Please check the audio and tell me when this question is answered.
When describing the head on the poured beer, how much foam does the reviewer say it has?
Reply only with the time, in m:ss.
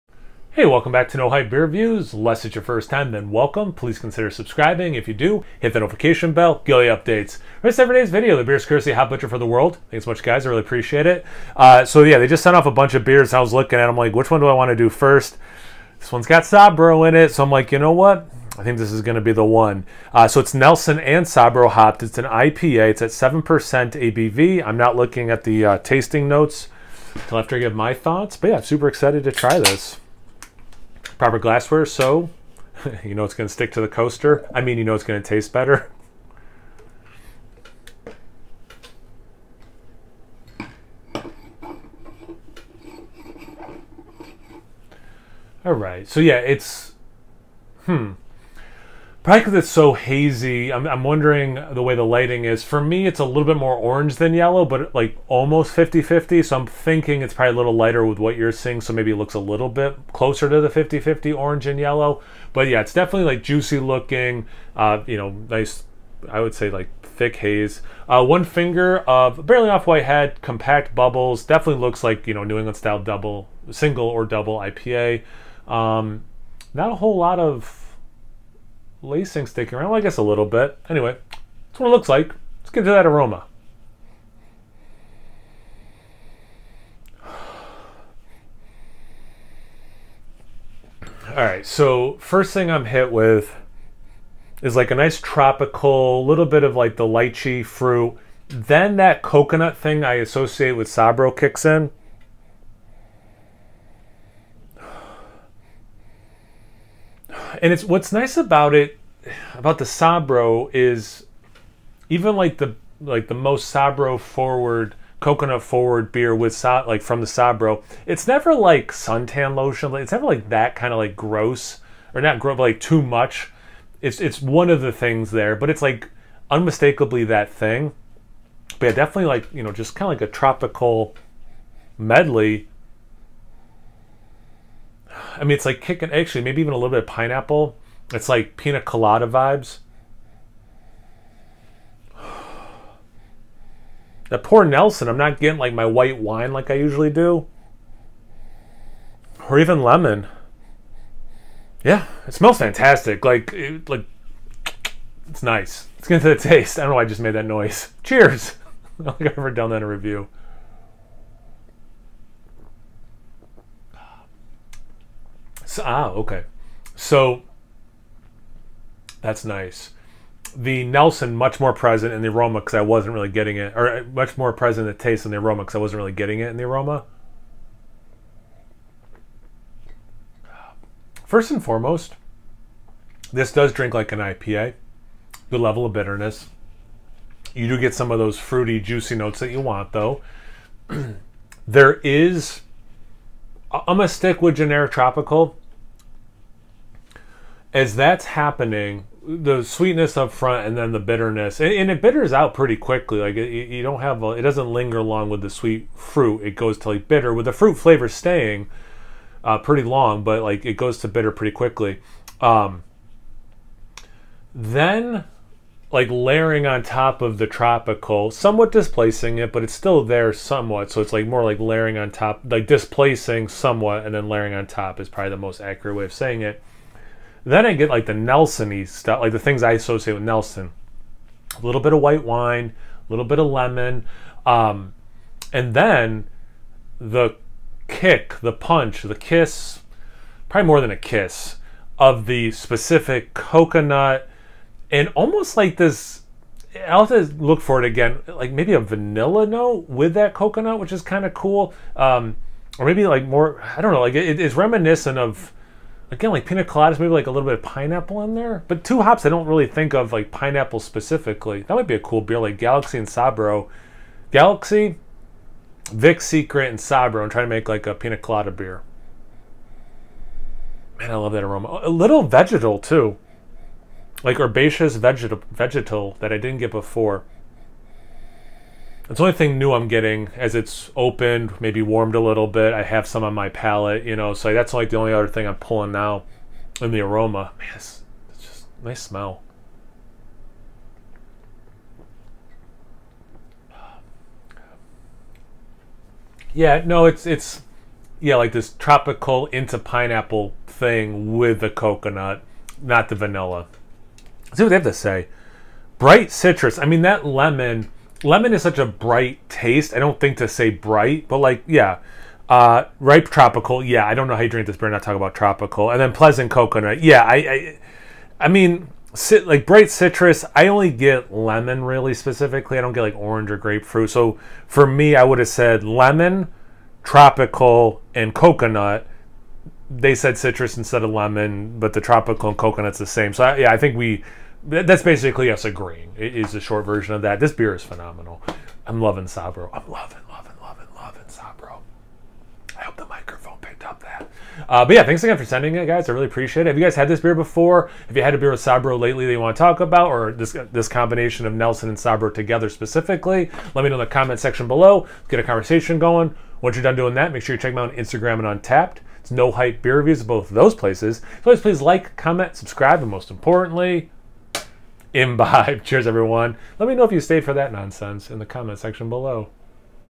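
1:08.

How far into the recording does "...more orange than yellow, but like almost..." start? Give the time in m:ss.
0:53.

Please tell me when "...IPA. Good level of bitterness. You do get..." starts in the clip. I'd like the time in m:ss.
3:04.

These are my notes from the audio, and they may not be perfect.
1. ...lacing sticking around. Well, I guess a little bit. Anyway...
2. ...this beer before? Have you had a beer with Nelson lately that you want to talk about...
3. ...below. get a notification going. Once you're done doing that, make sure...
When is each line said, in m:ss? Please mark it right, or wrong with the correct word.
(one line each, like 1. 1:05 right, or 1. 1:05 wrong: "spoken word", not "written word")
1. 1:19 right
2. 5:47 wrong: "Sabro", not "Nelson"
3. 5:54 wrong: "conversation", not "notification".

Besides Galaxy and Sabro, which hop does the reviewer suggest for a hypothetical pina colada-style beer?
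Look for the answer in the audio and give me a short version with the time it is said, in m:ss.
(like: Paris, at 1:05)
Vic Secret, at 4:25.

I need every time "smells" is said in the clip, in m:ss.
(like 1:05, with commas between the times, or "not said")
2:32, 4:49.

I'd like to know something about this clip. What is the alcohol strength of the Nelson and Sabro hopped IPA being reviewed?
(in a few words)
7% ABV.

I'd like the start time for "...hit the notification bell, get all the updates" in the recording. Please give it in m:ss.
0:05.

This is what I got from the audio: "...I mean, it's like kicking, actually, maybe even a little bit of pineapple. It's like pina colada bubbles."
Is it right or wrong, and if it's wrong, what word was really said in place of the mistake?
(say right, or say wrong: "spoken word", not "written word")
wrong: "vibes", not "bubbles".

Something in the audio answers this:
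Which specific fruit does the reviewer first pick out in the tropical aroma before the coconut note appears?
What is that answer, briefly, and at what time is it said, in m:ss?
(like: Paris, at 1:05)
Lychee, at 1:37.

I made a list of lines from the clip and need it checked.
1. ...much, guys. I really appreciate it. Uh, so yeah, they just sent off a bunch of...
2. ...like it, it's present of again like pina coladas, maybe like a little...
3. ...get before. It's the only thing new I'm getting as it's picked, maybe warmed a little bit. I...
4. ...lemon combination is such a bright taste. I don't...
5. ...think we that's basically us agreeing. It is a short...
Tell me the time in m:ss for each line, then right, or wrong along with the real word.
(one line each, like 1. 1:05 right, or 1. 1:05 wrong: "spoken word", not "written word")
1. 0:10 right
2. 4:13 wrong: "reminiscent", not "present"
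3. 4:36 wrong: "opened", not "picked"
4. 5:07 wrong: "lemon", not "combination"
5. 5:33 right.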